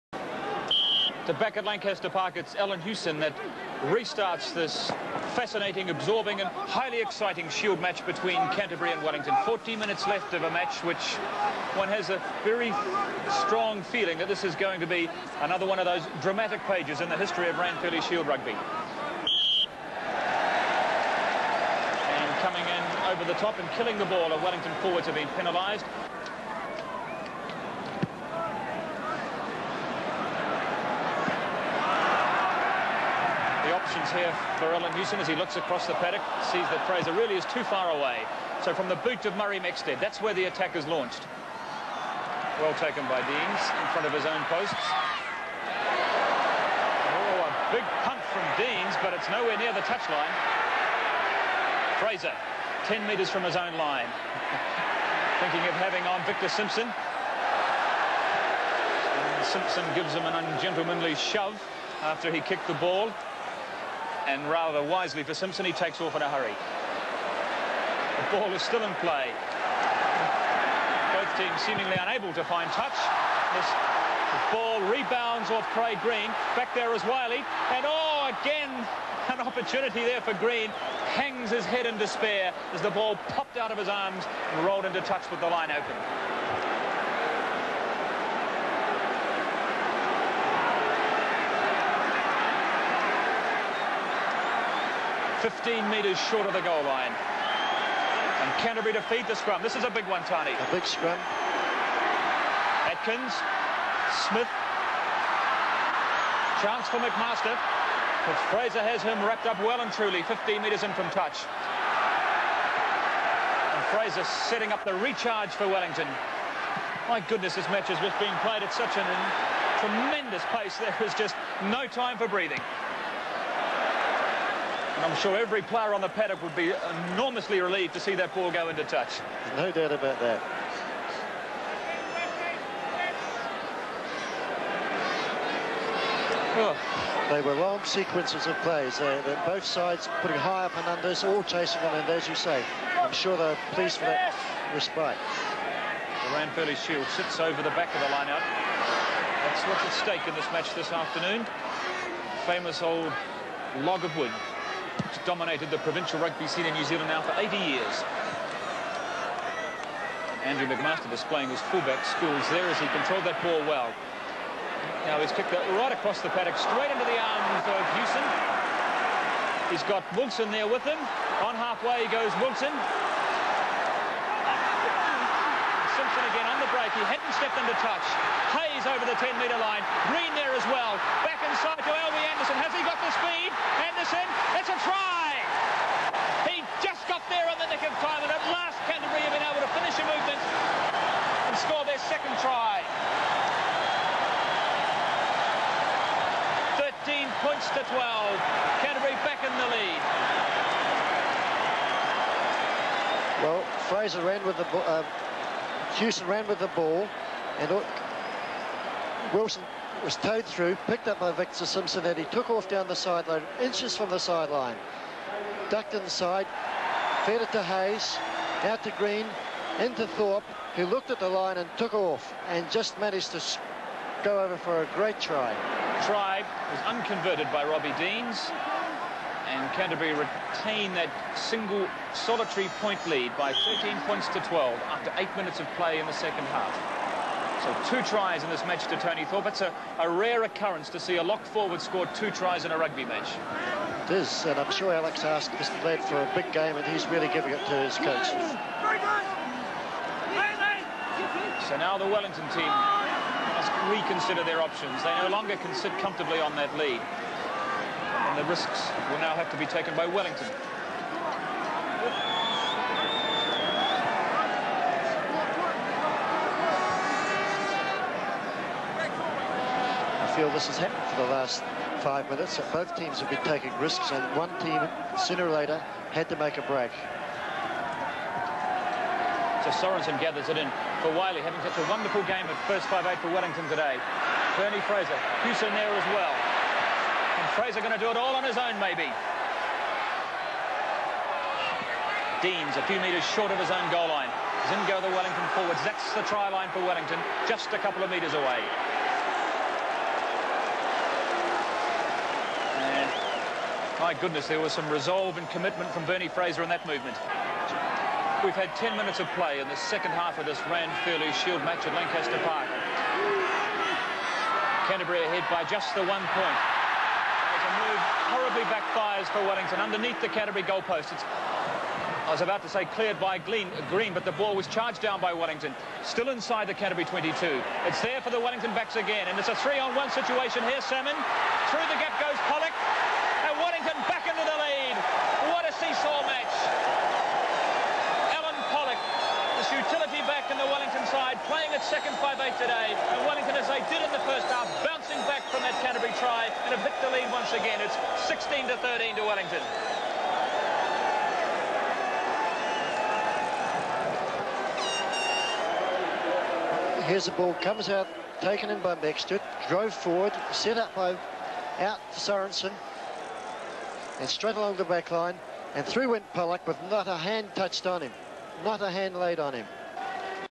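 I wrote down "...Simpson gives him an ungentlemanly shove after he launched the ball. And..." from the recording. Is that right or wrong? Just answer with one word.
wrong.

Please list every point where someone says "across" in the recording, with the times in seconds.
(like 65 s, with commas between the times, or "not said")
35 s, 165 s.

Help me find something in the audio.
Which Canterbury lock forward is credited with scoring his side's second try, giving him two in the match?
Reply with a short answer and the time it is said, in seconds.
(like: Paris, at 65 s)
Tony Thorpe, at 238 s.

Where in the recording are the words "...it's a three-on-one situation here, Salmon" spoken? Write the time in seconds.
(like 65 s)
329 s.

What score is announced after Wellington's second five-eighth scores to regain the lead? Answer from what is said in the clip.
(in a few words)
16 to 13.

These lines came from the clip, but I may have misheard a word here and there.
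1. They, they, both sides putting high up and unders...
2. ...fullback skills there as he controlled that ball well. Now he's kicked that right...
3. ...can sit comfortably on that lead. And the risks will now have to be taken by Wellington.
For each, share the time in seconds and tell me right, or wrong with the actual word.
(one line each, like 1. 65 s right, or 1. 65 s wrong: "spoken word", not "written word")
1. 138 s right
2. 161 s right
3. 255 s right.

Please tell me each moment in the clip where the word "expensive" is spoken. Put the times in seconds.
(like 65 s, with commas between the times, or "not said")
not said.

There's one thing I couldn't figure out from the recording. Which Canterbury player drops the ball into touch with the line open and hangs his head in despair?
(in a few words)
Craig Green.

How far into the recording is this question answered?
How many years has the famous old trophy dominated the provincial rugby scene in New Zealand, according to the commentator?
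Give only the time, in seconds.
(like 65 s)
157 s.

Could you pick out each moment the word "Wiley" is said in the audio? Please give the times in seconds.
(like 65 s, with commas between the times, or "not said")
77 s, 281 s.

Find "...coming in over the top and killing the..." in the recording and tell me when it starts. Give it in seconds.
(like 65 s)
22 s.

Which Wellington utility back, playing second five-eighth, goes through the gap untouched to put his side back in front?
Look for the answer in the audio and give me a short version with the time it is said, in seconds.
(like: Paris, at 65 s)
Alan Pollock, at 338 s.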